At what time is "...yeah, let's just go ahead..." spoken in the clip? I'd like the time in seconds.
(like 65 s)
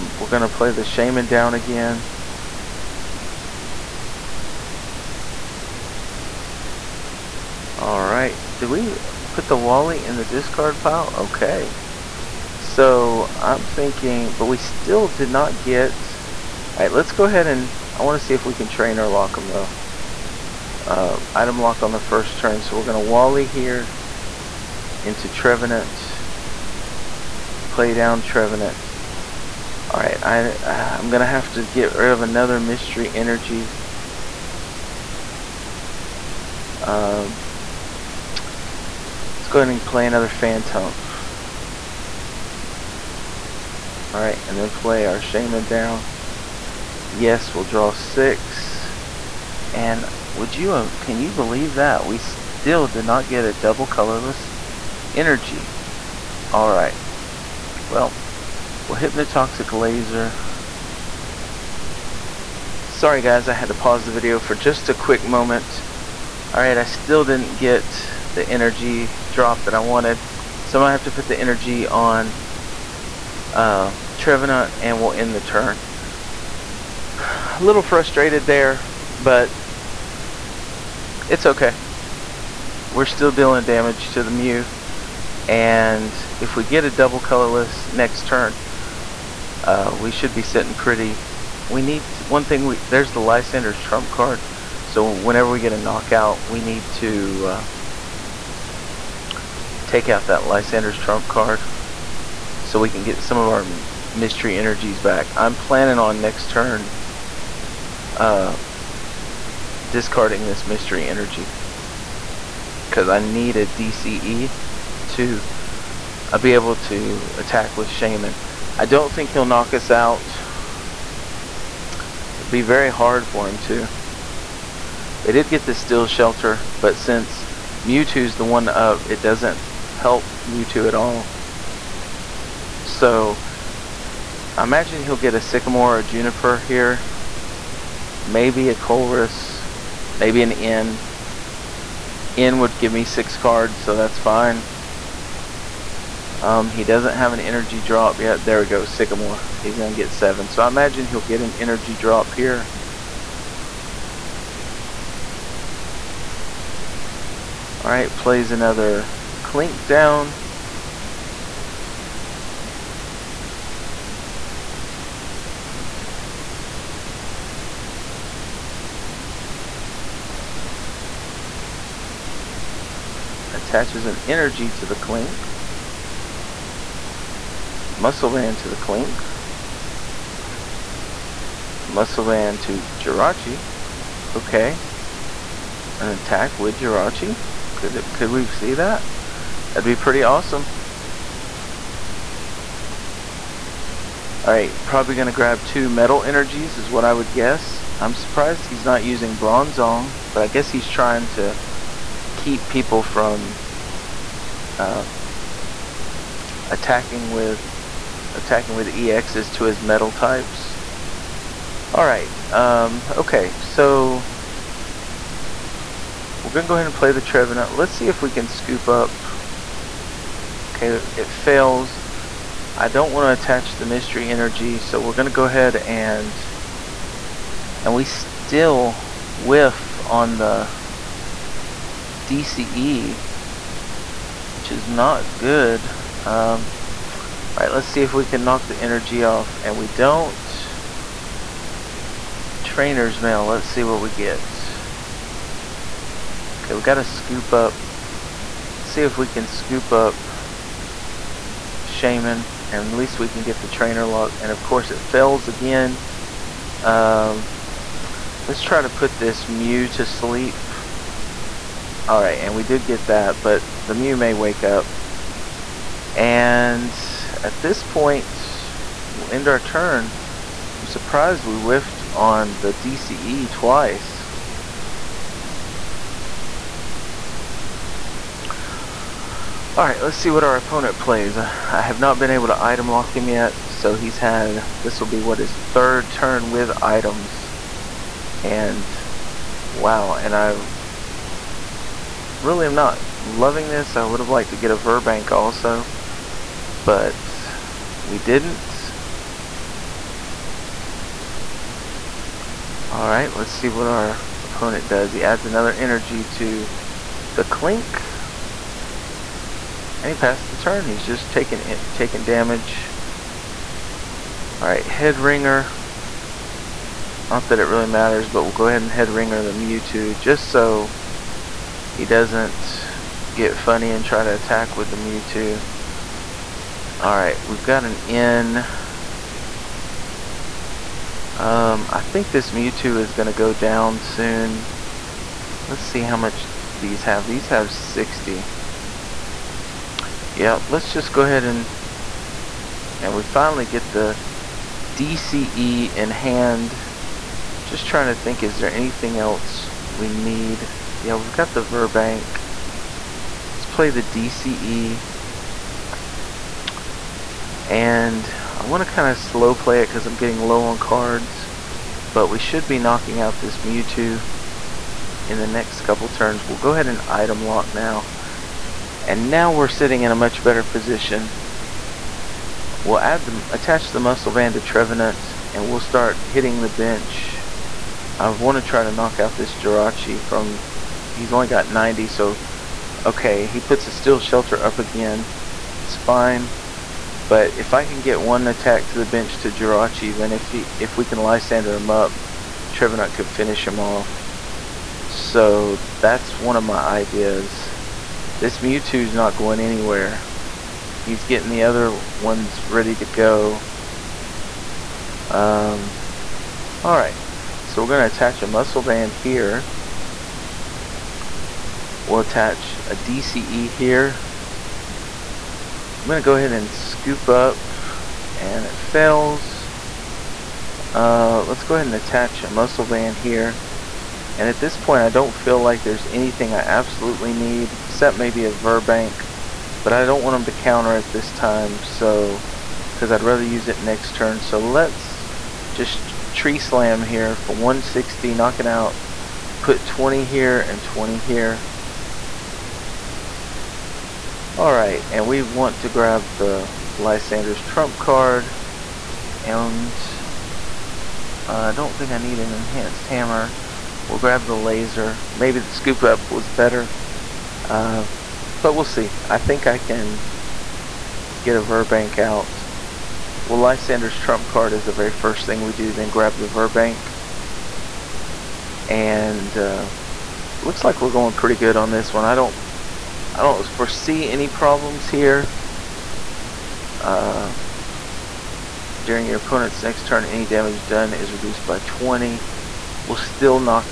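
340 s.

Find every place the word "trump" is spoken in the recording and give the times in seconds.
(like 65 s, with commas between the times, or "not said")
93 s, 100 s, 447 s, 464 s.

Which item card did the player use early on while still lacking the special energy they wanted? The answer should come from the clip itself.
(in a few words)
Hypnotoxic Laser.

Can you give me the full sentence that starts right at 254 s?
And of course, it fails again.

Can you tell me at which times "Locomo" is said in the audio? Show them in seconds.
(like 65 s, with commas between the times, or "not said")
19 s.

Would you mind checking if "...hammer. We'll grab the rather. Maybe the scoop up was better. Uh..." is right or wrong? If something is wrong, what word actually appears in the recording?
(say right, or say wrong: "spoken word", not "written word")
wrong: "laser", not "rather".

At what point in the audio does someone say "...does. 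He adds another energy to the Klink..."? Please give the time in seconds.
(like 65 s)
304 s.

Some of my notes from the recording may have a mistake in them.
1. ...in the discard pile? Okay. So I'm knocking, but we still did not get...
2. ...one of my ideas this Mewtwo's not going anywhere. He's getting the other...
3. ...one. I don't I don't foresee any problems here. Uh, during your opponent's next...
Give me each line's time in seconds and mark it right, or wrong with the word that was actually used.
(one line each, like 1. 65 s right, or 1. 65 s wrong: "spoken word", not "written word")
1. 10 s wrong: "thinking", not "knocking"
2. 396 s right
3. 472 s right.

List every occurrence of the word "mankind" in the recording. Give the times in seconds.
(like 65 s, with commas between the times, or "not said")
not said.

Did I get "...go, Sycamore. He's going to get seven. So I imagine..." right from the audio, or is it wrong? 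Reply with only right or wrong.
right.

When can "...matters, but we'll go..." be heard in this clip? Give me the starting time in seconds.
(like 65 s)
317 s.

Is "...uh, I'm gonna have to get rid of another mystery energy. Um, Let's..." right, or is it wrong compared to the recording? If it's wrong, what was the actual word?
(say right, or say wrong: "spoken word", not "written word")
right.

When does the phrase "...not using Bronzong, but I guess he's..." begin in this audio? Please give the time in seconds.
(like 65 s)
198 s.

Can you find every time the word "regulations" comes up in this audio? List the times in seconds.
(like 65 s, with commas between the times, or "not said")
not said.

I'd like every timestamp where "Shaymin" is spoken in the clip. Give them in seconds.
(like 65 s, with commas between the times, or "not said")
0 s, 45 s, 117 s, 251 s.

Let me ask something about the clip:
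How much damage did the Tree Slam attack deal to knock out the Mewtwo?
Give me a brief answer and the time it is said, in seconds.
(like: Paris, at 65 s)
160, at 437 s.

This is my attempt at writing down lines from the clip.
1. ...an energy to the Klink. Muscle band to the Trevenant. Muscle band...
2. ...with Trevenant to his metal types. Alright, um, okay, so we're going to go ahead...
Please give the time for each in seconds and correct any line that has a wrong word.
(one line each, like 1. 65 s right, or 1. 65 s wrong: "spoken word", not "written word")
1. 174 s wrong: "Klink", not "Trevenant"
2. 208 s wrong: "EXs", not "Trevenant".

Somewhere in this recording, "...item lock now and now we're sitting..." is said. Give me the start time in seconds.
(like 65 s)
367 s.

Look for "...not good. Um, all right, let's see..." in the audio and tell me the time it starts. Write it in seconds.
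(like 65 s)
234 s.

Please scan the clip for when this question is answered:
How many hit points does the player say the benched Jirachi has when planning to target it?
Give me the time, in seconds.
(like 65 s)
381 s.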